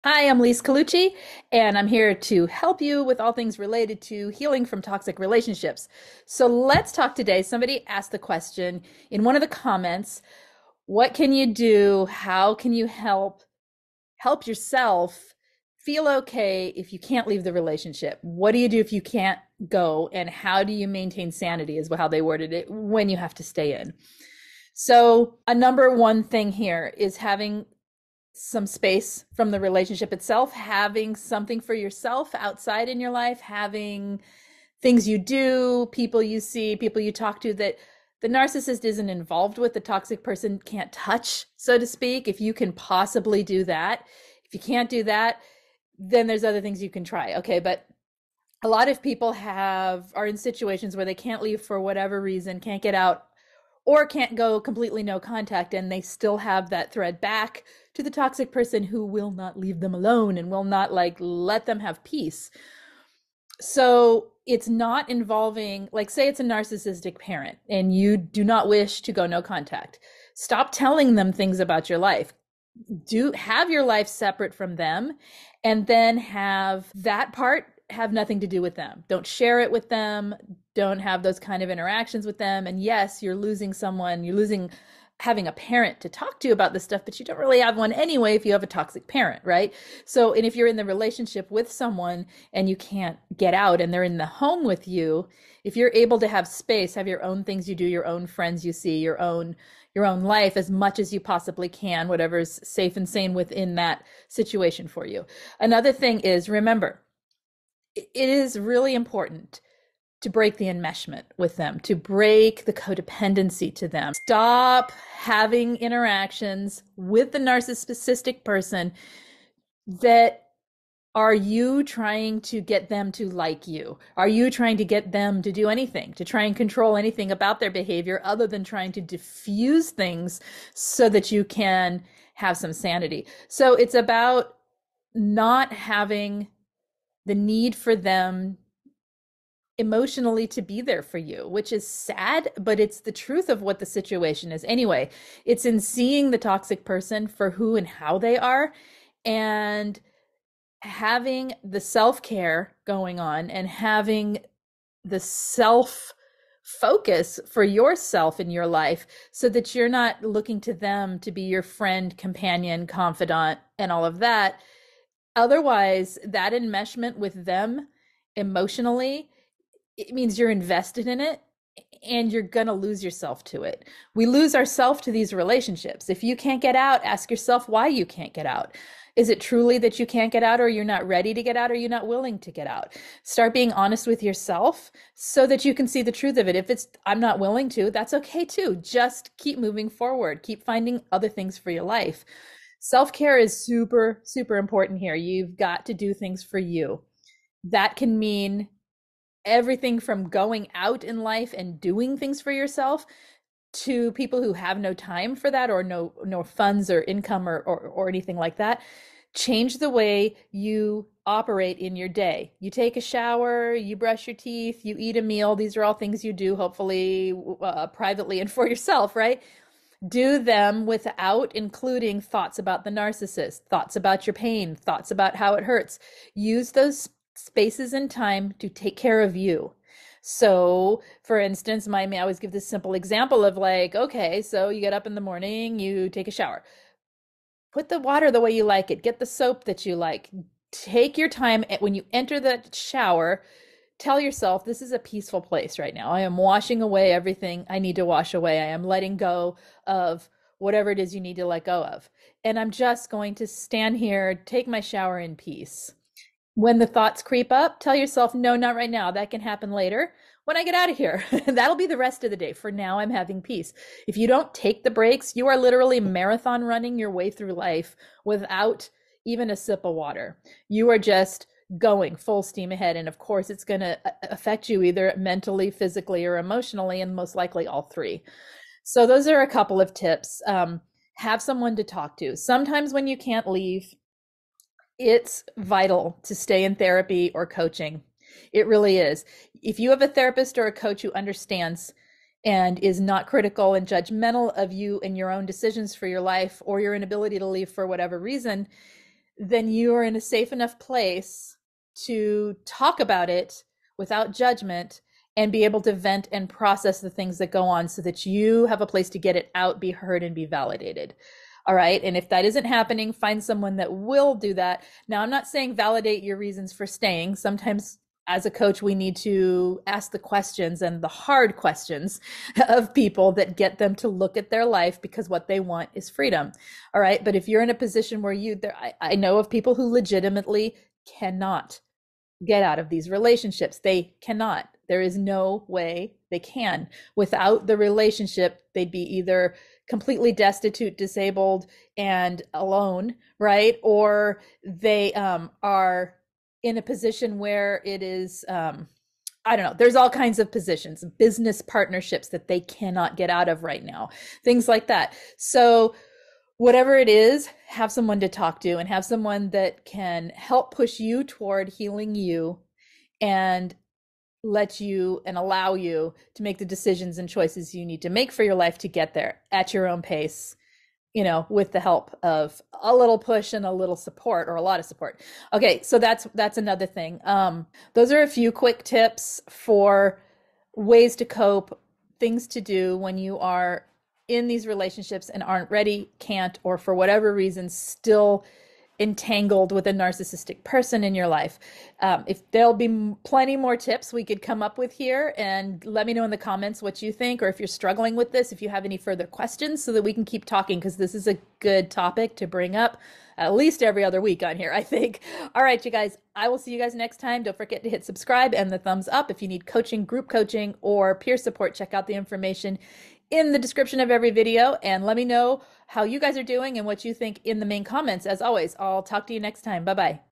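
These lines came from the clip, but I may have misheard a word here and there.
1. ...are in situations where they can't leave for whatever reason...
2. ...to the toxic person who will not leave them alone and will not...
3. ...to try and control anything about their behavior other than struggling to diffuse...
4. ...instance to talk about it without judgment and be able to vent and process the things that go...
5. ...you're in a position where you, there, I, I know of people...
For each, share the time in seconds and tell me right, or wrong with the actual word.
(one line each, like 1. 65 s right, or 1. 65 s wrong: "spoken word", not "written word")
1. 50 s right
2. 57 s right
3. 126 s wrong: "trying", not "struggling"
4. 300 s wrong: "place", not "instance"
5. 327 s right.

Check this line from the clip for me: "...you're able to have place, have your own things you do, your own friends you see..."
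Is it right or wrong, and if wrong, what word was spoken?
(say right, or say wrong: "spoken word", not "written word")
wrong: "space", not "place".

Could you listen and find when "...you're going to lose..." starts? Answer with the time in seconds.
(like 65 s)
172 s.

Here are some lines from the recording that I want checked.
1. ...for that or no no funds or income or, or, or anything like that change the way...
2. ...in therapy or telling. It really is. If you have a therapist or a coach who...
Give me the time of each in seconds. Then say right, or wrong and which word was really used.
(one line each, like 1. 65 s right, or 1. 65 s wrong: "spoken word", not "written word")
1. 205 s right
2. 286 s wrong: "coaching", not "telling".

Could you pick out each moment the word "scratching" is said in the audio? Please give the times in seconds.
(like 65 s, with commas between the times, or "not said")
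not said.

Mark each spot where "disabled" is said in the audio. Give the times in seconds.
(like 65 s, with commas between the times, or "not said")
340 s.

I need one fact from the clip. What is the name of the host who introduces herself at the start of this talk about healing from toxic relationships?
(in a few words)
Lise Colucci.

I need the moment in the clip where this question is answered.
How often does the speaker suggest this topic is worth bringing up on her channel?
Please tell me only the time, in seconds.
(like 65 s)
403 s.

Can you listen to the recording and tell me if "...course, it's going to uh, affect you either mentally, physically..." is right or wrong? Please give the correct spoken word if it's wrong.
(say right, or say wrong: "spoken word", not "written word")
right.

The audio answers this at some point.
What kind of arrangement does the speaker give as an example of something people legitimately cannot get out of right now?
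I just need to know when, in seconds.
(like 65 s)
351 s.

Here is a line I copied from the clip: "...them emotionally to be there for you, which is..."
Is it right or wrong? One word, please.
right.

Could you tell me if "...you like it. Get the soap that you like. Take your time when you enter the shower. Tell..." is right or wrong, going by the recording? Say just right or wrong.
right.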